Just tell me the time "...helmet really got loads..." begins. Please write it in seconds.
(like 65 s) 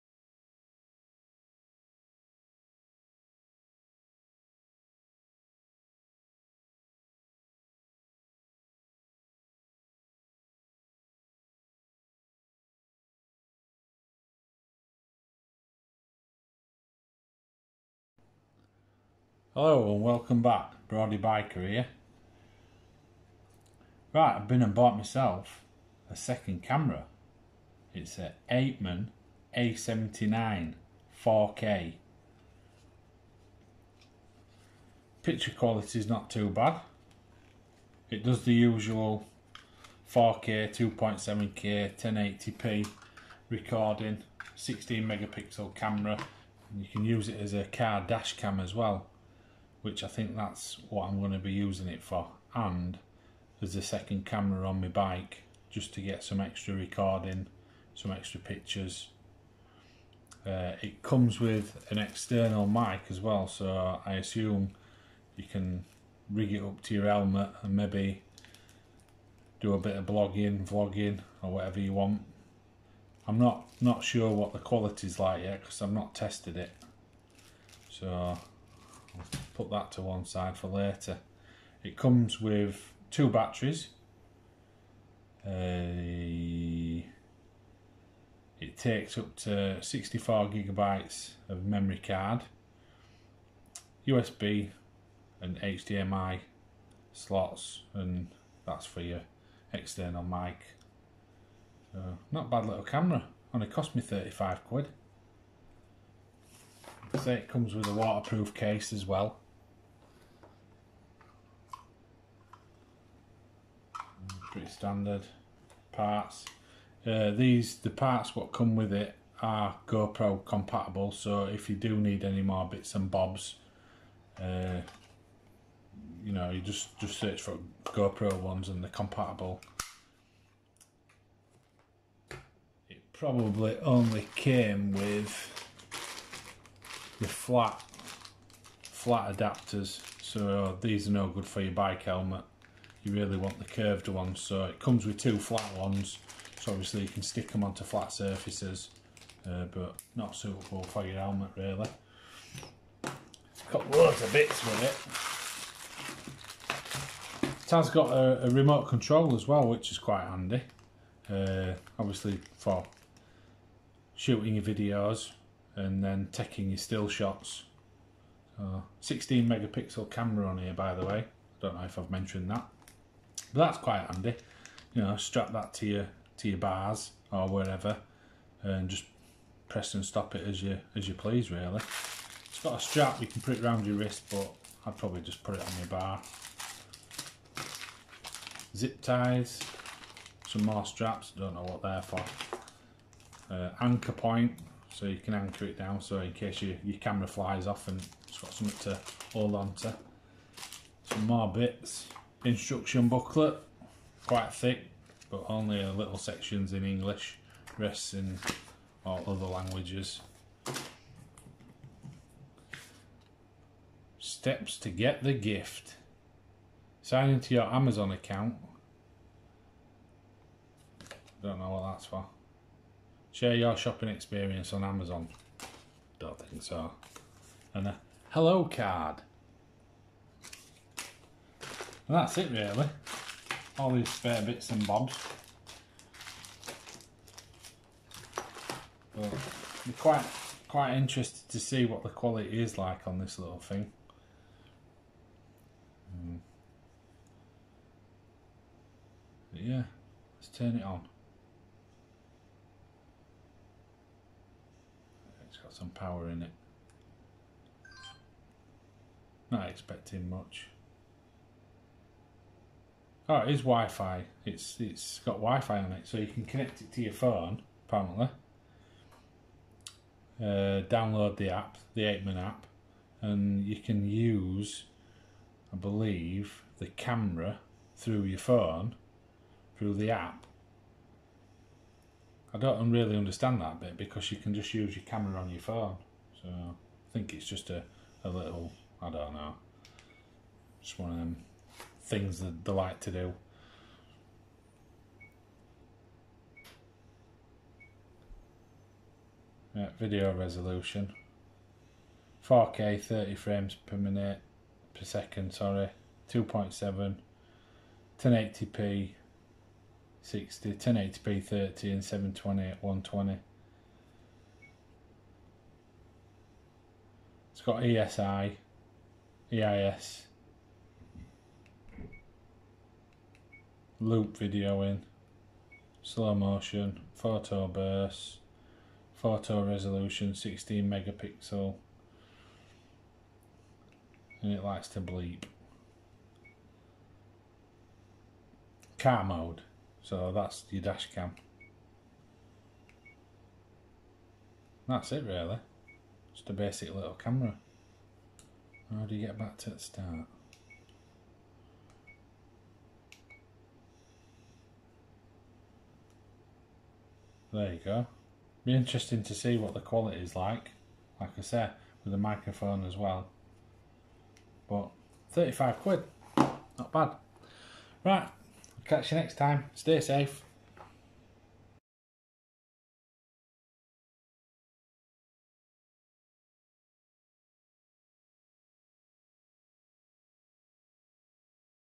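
151 s.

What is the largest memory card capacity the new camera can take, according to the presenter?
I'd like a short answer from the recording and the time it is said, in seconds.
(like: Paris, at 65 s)
64 gigabytes, at 89 s.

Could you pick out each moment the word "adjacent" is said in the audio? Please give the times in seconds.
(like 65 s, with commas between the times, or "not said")
not said.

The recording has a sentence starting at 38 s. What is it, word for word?
It does the usual 4K, 2.7K, 1080p recording, 16 megapixel camera.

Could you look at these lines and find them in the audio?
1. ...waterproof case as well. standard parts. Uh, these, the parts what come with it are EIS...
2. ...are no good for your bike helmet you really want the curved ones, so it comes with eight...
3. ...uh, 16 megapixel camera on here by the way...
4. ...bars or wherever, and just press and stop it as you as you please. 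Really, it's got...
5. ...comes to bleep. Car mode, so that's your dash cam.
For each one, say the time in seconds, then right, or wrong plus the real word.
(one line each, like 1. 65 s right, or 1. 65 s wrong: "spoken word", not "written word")
1. 107 s wrong: "GoPro", not "EIS"
2. 141 s wrong: "two", not "eight"
3. 168 s right
4. 176 s right
5. 334 s wrong: "likes", not "comes".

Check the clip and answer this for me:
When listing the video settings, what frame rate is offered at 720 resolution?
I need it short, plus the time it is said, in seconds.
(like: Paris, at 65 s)
120, at 312 s.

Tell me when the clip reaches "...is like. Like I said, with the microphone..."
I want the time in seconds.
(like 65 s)
360 s.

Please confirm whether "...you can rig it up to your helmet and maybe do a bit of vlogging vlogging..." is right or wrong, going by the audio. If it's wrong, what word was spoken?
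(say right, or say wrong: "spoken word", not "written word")
wrong: "blogging", not "vlogging".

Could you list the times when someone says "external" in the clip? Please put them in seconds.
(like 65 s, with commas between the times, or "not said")
61 s, 99 s.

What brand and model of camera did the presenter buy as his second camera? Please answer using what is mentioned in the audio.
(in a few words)
Apeman A79.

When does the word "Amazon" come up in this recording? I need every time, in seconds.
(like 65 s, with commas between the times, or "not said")
217 s, 224 s.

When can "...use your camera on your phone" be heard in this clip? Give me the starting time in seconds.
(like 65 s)
284 s.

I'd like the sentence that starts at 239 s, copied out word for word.
But I'm quite, quite interested to see what the quality is like on this little thing.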